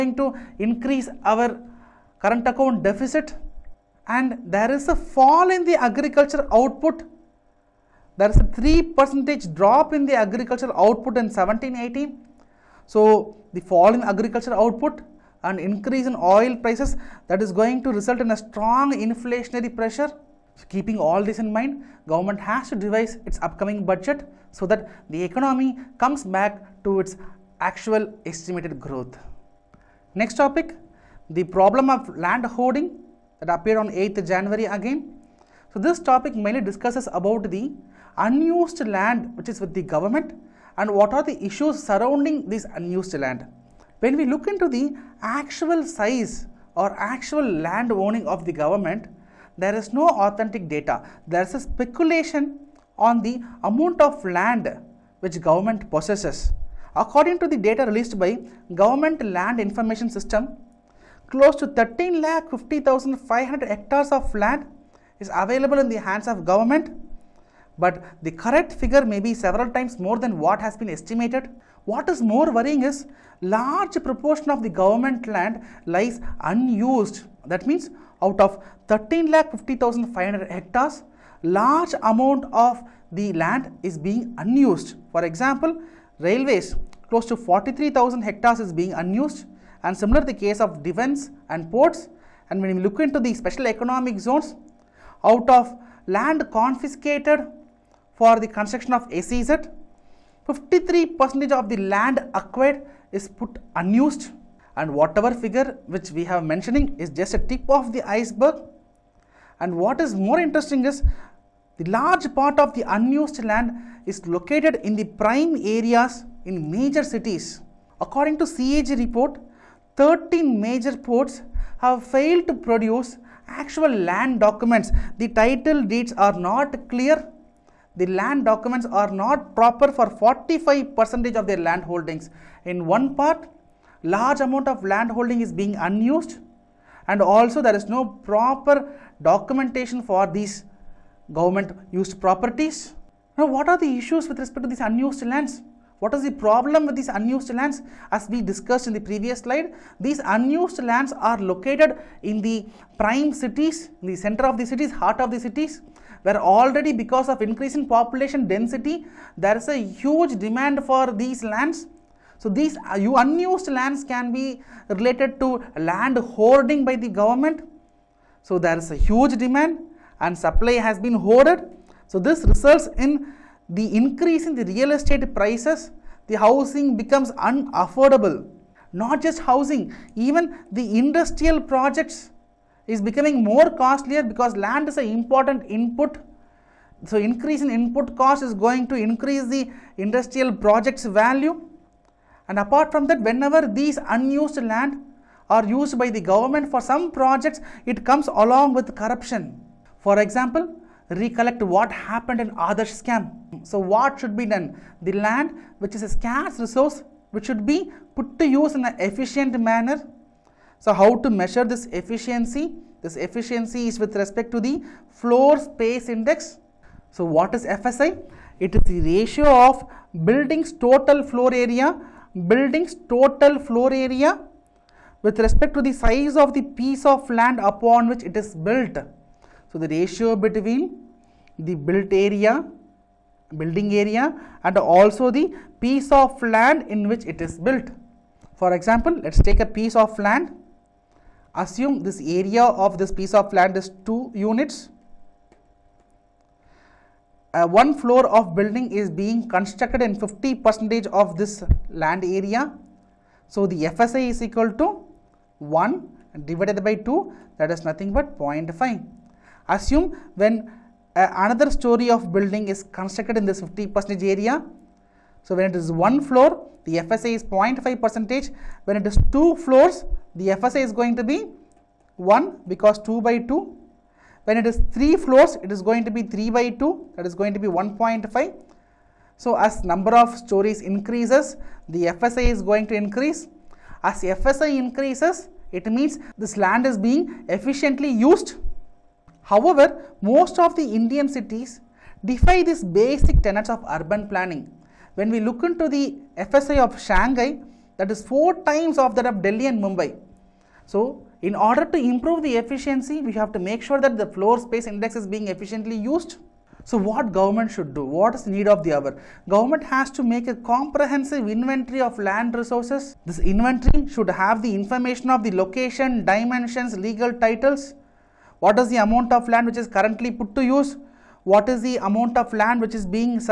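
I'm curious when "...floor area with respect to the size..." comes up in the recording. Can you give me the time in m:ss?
3:43.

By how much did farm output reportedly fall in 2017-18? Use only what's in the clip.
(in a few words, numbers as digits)
3 percentage.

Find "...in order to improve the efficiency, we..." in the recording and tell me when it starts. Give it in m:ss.
5:01.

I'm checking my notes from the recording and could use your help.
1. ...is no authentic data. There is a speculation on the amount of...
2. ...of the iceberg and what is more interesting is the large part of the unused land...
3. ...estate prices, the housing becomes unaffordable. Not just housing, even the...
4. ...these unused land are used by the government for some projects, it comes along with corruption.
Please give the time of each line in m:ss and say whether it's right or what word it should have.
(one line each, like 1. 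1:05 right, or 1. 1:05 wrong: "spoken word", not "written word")
1. 0:49 right
2. 1:47 right
3. 2:54 right
4. 3:13 right.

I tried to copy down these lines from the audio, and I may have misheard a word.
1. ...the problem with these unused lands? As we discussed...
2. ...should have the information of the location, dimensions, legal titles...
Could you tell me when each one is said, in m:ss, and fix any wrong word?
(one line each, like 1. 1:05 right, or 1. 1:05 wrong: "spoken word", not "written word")
1. 2:26 right
2. 5:14 right.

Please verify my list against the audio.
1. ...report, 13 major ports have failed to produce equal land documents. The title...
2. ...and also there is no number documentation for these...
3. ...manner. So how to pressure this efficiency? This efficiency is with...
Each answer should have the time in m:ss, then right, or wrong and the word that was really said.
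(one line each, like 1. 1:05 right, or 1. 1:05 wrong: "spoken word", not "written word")
1. 1:59 wrong: "actual", not "equal"
2. 2:17 wrong: "proper", not "number"
3. 3:29 wrong: "measure", not "pressure".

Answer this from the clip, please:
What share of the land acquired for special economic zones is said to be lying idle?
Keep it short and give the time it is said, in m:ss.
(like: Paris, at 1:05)
53 percentage, at 1:40.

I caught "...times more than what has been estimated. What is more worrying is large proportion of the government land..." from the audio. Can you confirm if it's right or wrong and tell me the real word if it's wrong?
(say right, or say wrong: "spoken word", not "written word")
right.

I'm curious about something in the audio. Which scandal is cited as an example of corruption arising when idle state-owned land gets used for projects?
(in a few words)
Adarsh scam.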